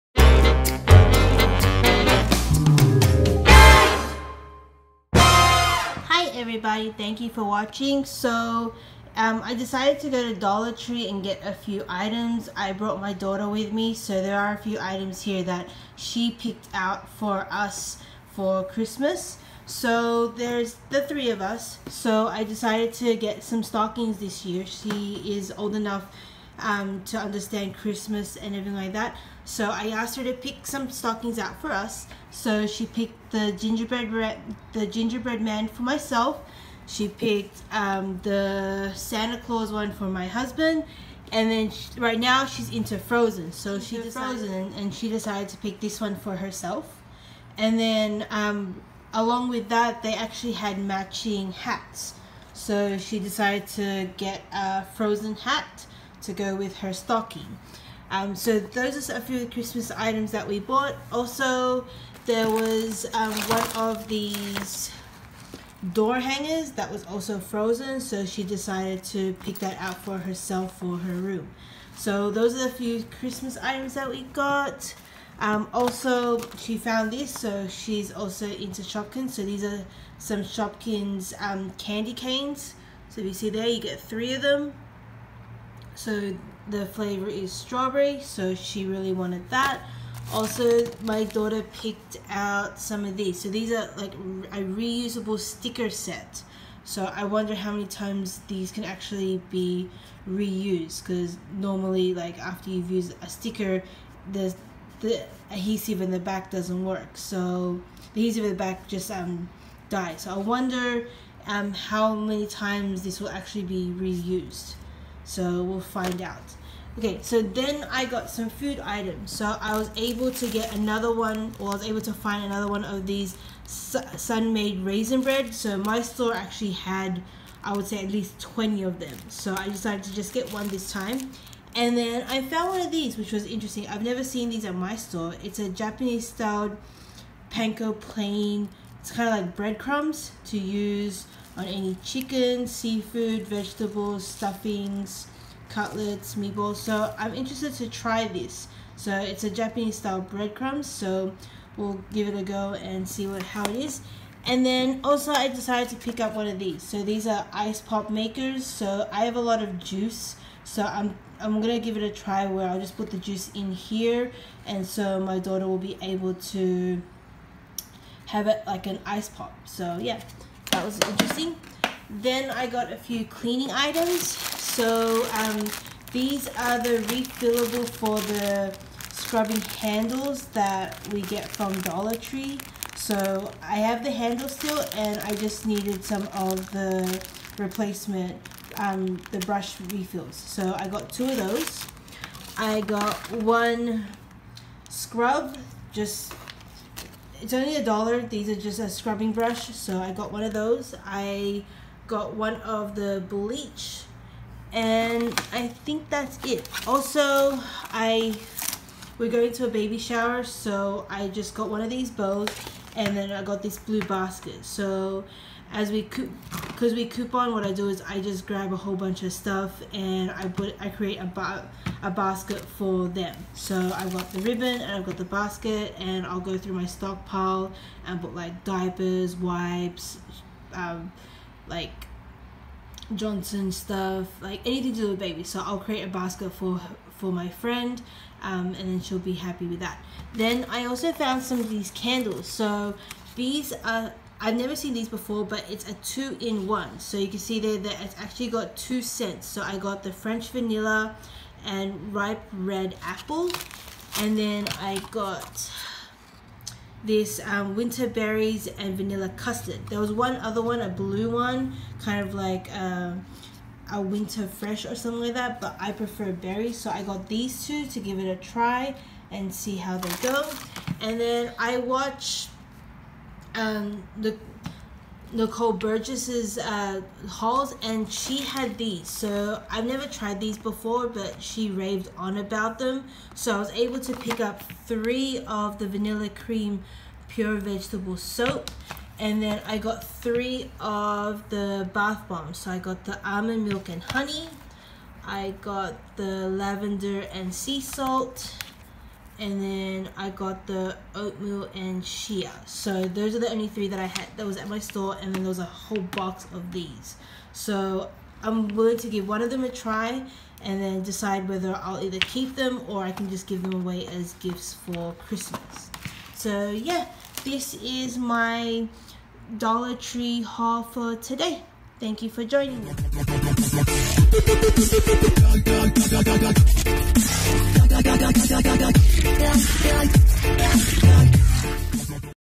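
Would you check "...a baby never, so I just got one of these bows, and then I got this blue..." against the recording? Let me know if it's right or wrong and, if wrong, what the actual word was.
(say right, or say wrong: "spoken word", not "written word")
wrong: "shower", not "never".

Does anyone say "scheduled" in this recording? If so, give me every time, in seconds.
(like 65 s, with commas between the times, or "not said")
not said.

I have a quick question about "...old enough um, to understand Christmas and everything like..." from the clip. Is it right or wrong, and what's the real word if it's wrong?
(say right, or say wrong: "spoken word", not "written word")
right.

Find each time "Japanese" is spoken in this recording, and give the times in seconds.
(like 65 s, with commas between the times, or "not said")
135 s, 149 s.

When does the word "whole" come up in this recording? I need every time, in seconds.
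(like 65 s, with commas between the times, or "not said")
218 s, 305 s.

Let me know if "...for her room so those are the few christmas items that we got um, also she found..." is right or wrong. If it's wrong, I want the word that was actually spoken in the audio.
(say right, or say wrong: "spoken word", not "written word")
right.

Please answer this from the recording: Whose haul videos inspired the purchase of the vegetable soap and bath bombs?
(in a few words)
Nicole Burgess.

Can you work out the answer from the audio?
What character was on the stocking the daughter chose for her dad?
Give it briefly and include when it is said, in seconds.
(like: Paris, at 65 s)
Santa Claus, at 38 s.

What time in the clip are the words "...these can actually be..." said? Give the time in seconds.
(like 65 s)
98 s.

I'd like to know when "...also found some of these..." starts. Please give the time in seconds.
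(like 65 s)
240 s.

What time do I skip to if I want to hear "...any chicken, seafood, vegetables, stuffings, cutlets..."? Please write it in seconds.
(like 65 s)
141 s.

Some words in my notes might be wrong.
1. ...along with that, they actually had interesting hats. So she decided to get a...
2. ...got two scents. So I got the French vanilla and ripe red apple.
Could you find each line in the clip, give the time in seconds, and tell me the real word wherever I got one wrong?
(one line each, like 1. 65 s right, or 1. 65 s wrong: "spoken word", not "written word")
1. 49 s wrong: "matching", not "interesting"
2. 248 s right.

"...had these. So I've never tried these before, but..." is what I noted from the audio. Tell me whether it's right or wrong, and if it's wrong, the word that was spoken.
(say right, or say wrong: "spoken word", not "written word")
right.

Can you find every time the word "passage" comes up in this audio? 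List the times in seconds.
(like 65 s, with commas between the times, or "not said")
not said.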